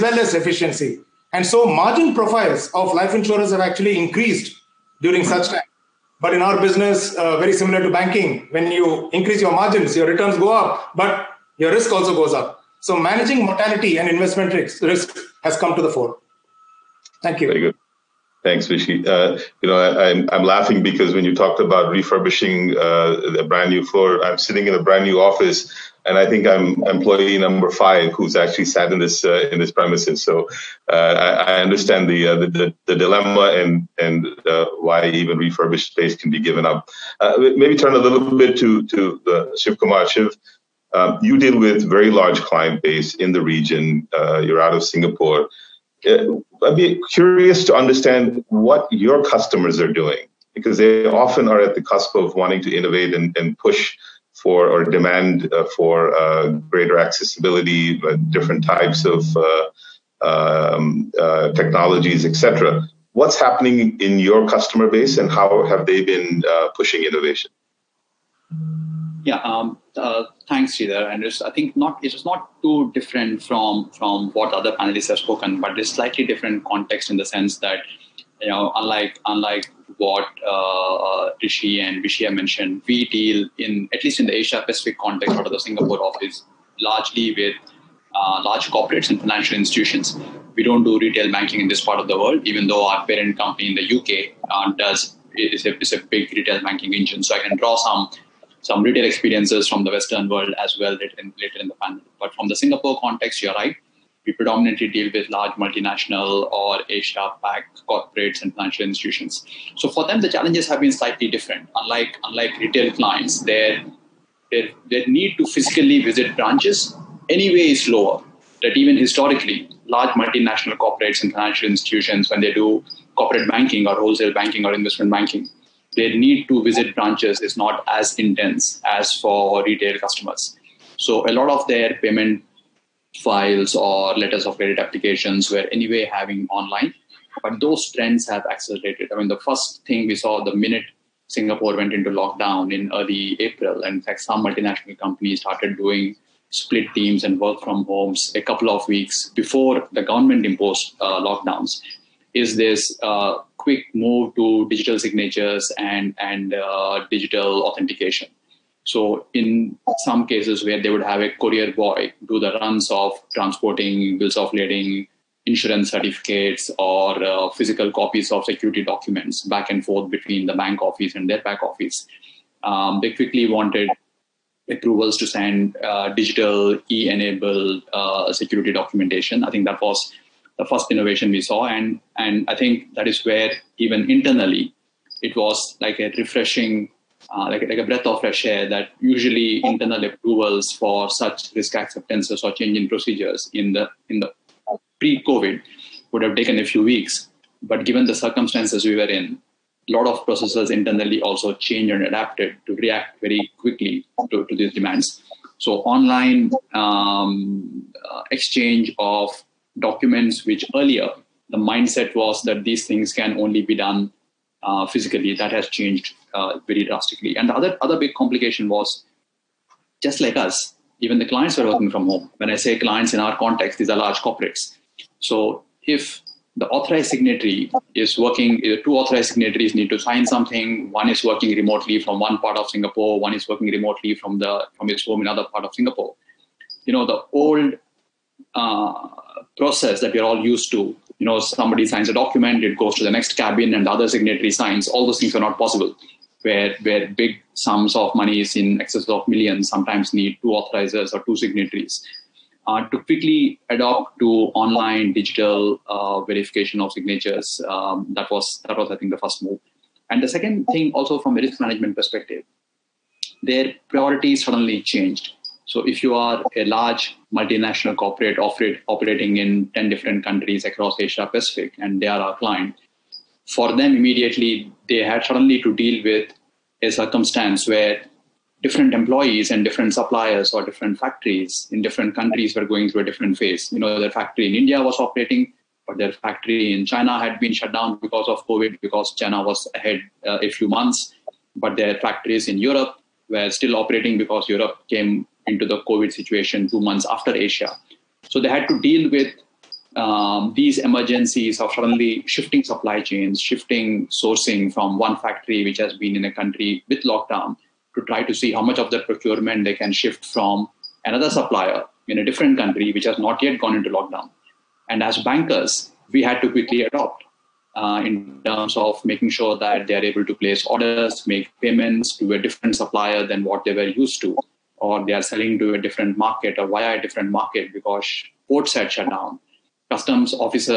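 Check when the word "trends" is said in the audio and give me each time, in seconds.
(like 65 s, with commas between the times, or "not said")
137 s.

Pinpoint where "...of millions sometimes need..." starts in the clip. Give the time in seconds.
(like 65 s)
249 s.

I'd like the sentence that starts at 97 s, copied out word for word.
So I can draw some some retail experiences from the Western world as well later in, later in the panel.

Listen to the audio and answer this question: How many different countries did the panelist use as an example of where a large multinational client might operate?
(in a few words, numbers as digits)
10.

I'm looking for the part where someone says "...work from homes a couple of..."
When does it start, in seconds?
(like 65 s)
147 s.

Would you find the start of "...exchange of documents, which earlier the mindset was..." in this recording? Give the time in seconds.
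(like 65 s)
208 s.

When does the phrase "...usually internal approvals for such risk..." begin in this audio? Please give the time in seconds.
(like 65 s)
188 s.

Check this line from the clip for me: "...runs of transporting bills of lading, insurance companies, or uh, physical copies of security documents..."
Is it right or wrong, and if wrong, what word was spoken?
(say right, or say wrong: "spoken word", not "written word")
wrong: "certificates", not "companies".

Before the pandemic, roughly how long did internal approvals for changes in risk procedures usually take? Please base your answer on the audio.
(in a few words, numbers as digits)
a few weeks.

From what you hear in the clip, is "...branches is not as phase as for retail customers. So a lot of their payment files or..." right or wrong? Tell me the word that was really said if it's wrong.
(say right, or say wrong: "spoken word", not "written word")
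wrong: "intense", not "phase".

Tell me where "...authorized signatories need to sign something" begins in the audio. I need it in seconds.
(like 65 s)
228 s.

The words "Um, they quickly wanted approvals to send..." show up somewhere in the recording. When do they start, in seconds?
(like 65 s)
172 s.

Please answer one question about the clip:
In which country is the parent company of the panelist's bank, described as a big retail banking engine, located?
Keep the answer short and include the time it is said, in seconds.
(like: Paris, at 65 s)
UK, at 93 s.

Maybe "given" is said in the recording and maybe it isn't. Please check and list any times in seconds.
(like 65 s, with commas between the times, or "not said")
36 s, 197 s.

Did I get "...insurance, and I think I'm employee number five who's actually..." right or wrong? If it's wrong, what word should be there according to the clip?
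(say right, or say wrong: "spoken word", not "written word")
wrong: "office", not "insurance".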